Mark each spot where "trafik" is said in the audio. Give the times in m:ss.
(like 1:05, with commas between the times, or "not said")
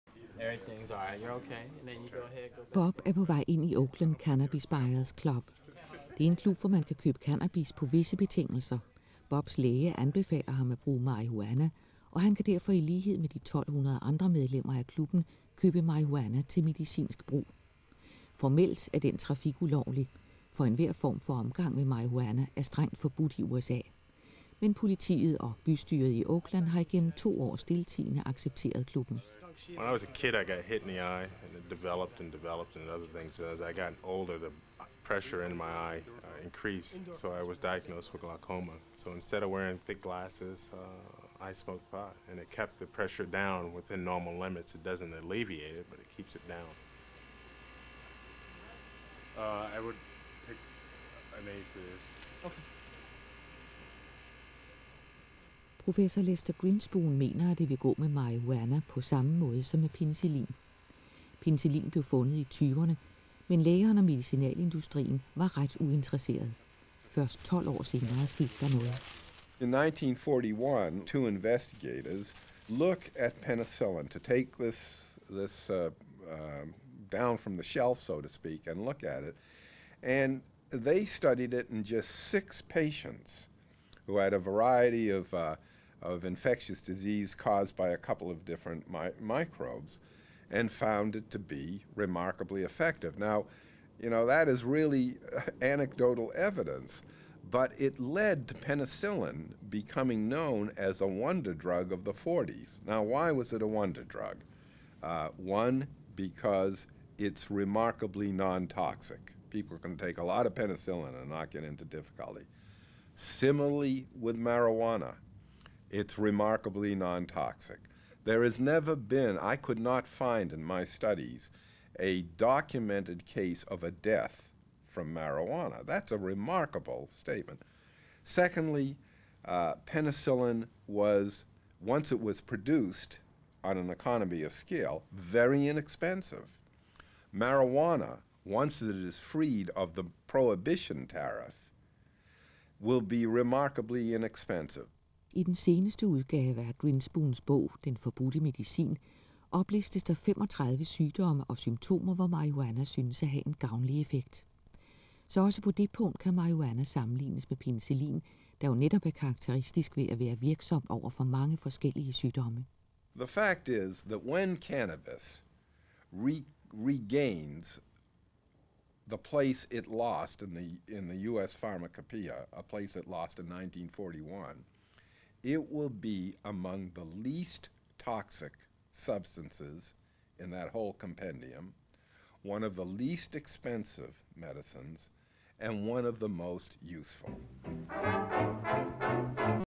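0:19.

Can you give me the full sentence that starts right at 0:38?
So instead of wearing thick glasses, uh, I smoked pot, and it kept the pressure down within normal limits.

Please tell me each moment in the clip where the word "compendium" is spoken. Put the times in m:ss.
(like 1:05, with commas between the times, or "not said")
3:00.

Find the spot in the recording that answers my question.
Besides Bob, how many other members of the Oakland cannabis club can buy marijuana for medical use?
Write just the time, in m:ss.
0:13.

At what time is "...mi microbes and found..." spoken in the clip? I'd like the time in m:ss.
1:28.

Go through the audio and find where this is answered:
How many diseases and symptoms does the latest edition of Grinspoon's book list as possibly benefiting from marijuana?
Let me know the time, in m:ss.
2:30.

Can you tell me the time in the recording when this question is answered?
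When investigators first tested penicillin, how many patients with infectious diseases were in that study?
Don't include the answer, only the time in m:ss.
1:22.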